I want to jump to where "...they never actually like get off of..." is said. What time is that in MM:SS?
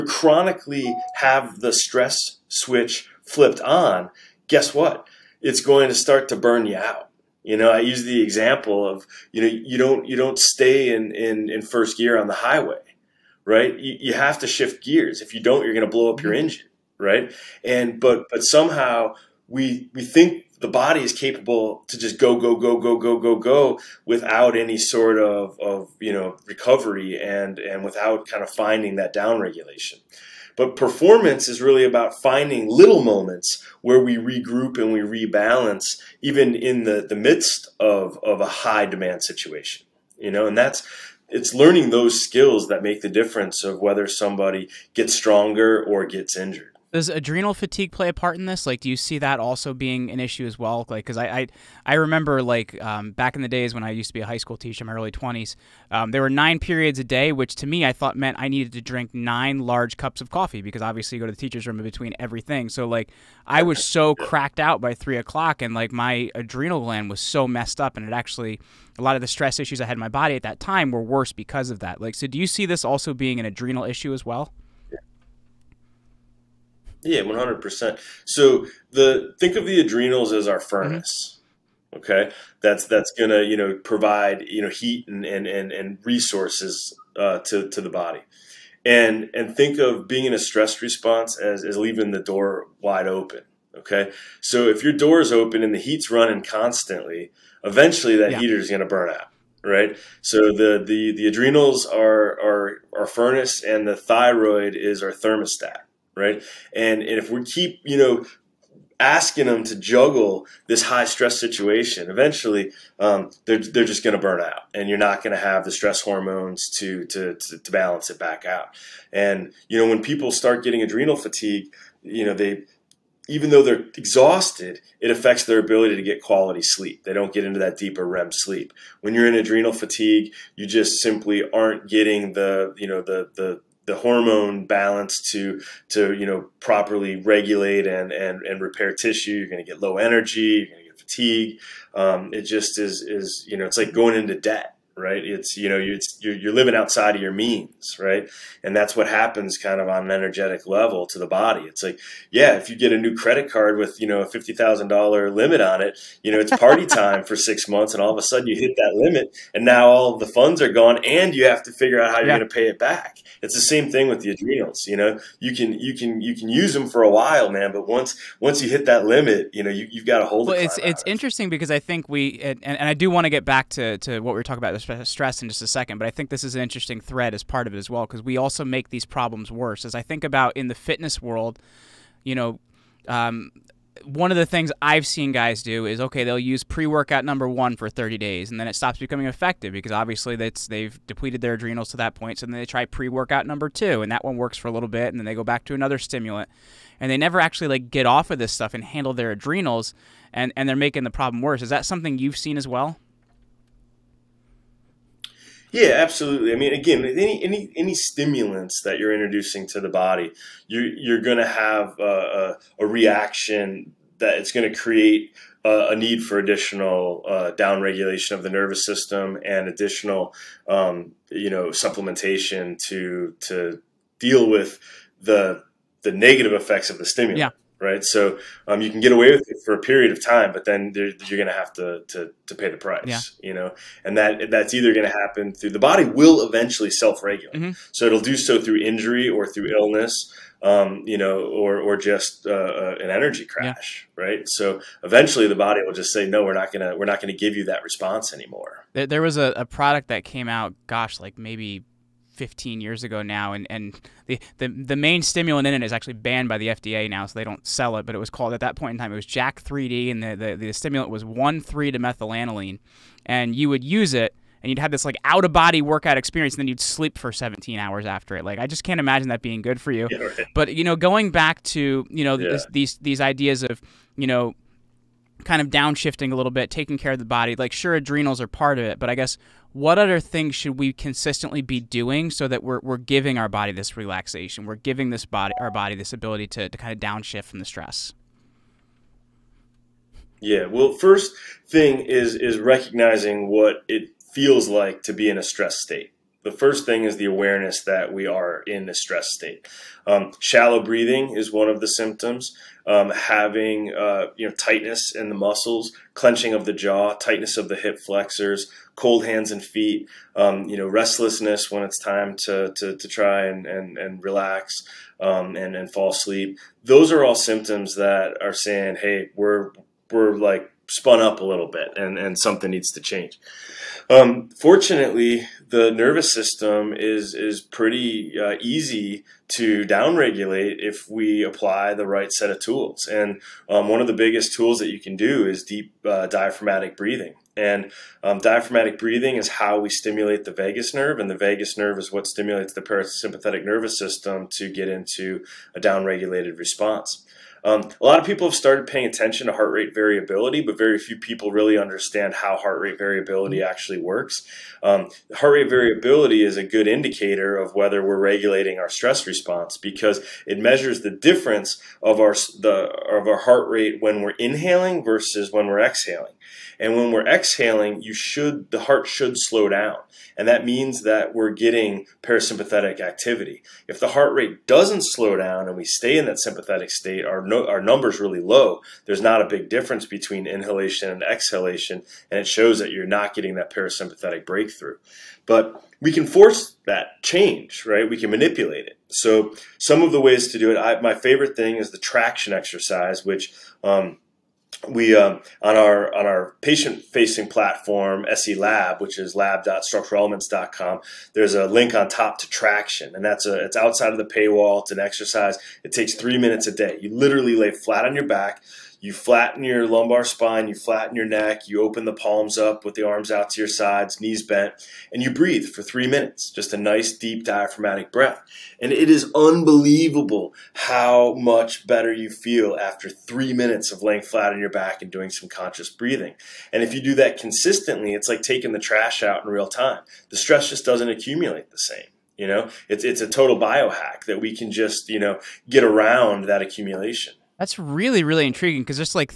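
03:17.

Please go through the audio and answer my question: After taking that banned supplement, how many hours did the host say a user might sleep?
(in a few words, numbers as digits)
17.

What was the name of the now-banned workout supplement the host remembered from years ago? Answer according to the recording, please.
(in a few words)
Jack 3D.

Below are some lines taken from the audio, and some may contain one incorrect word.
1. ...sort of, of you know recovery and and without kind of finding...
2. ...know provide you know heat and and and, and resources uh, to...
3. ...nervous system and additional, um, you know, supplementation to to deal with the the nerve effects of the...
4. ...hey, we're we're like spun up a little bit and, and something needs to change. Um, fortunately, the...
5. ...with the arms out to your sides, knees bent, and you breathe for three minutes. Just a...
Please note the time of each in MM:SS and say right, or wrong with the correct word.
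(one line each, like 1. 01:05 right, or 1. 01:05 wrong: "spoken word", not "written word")
1. 00:24 right
2. 01:23 right
3. 03:38 wrong: "negative", not "nerve"
4. 05:19 right
5. 06:52 right.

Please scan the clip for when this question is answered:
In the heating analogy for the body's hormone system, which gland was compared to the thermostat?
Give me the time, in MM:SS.
01:43.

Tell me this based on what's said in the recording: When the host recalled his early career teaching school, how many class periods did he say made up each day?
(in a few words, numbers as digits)
9.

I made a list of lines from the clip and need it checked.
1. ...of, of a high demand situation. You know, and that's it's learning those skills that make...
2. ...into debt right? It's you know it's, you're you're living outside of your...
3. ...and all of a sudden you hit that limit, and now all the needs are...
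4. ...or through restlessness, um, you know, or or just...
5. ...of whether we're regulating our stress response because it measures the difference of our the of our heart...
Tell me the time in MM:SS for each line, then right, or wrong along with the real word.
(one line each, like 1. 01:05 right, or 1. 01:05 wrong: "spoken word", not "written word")
1. 00:37 right
2. 02:24 right
3. 02:37 wrong: "funds", not "needs"
4. 03:59 wrong: "illness", not "restlessness"
5. 05:57 right.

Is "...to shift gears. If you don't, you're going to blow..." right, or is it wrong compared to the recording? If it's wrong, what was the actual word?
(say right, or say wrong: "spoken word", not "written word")
right.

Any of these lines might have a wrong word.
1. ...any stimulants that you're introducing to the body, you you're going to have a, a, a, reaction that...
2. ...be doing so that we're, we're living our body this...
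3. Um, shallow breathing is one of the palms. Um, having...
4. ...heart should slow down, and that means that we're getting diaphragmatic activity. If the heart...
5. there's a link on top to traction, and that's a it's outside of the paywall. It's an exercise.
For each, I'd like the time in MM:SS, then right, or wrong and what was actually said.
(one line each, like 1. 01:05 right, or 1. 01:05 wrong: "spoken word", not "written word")
1. 03:27 right
2. 04:41 wrong: "giving", not "living"
3. 05:00 wrong: "symptoms", not "palms"
4. 06:08 wrong: "parasympathetic", not "diaphragmatic"
5. 06:41 right.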